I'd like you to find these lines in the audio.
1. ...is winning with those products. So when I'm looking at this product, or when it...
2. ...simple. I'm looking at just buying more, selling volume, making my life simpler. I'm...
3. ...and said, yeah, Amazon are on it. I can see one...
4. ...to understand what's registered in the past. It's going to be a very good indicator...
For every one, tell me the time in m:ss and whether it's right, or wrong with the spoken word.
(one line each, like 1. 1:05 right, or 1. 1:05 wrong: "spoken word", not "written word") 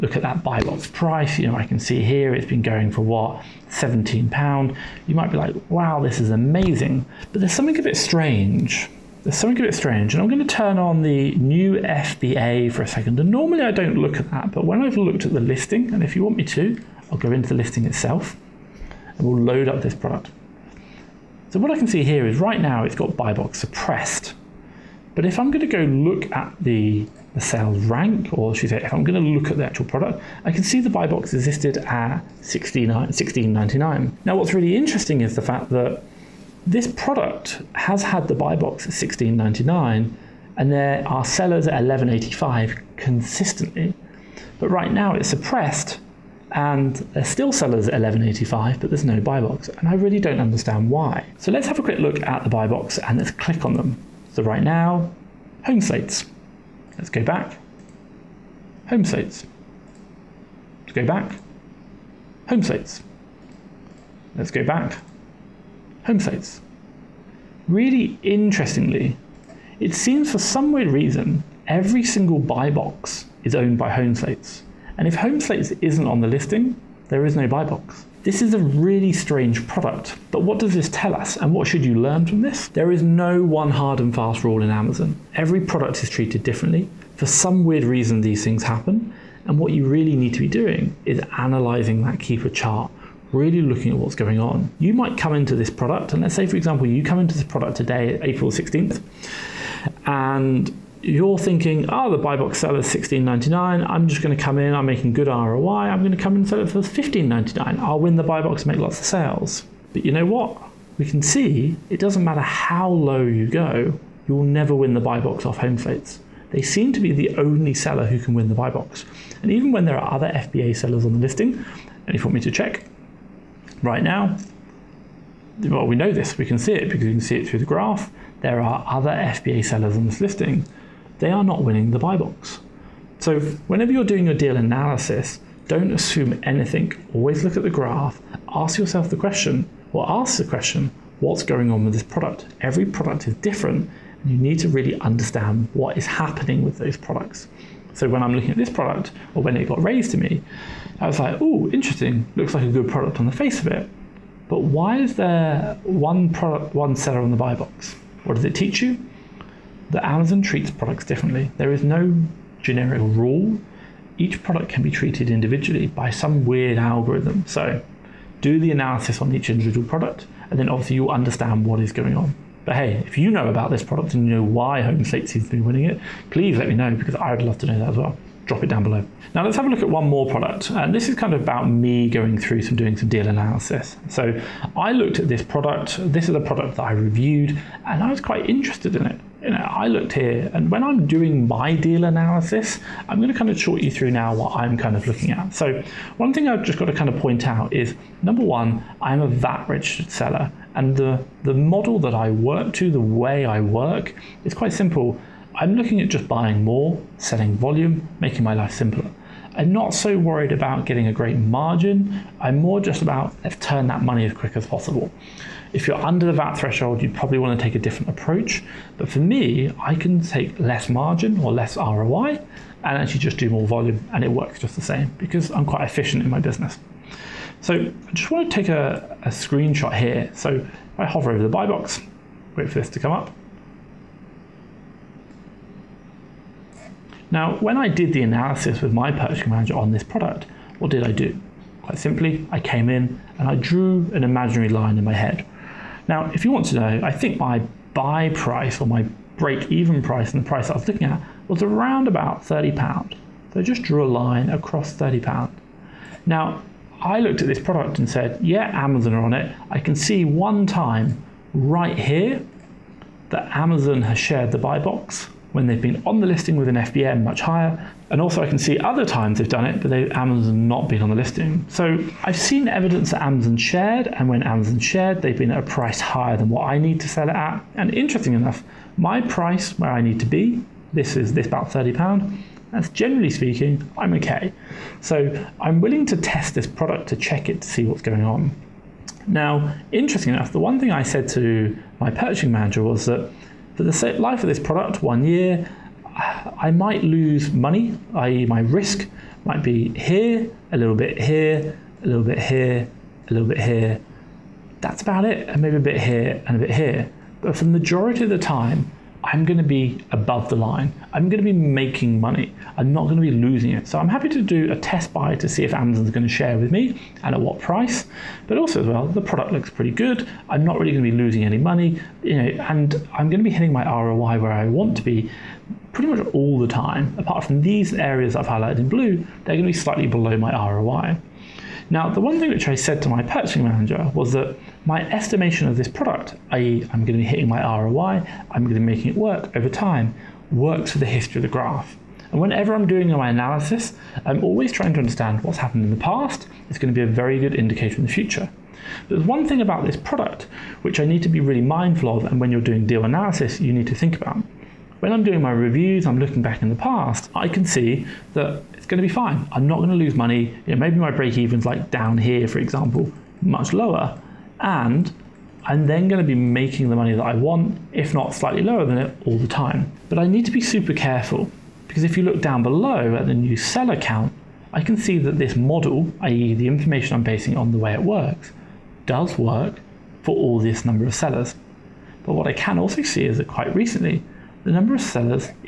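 1. 2:25 wrong: "happening", not "winning"
2. 3:24 right
3. 4:17 right
4. 5:44 wrong: "happened", not "registered".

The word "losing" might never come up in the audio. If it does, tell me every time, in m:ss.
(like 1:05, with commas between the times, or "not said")
5:13, 5:21.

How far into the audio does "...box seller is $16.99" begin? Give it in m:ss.
1:42.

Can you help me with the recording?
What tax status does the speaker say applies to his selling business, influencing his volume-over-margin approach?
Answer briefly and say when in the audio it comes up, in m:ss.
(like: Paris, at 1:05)
VAT registered, at 3:19.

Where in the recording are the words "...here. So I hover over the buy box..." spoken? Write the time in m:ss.
3:49.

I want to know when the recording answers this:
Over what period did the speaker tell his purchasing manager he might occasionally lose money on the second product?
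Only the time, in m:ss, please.
4:55.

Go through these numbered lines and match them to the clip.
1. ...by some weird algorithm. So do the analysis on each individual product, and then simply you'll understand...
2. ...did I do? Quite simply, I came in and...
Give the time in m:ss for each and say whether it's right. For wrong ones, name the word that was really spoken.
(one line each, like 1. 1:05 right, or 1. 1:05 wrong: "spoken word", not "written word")
1. 2:45 wrong: "obviously", not "simply"
2. 4:00 right.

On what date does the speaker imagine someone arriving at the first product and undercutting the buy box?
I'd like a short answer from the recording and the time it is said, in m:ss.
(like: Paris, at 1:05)
April 16th, at 1:38.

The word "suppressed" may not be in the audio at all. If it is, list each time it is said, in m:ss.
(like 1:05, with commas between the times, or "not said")
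0:23, 0:45.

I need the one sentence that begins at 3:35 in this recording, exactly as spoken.
If you're under the VAT threshold, you probably want to take a different approach.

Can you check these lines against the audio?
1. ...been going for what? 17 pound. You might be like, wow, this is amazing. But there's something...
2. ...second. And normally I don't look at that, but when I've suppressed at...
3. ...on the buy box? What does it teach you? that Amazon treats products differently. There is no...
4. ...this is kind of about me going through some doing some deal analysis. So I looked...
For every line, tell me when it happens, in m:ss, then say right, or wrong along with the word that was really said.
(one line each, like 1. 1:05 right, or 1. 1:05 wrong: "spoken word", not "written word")
1. 0:02 right
2. 0:12 wrong: "looked", not "suppressed"
3. 2:37 right
4. 3:00 right.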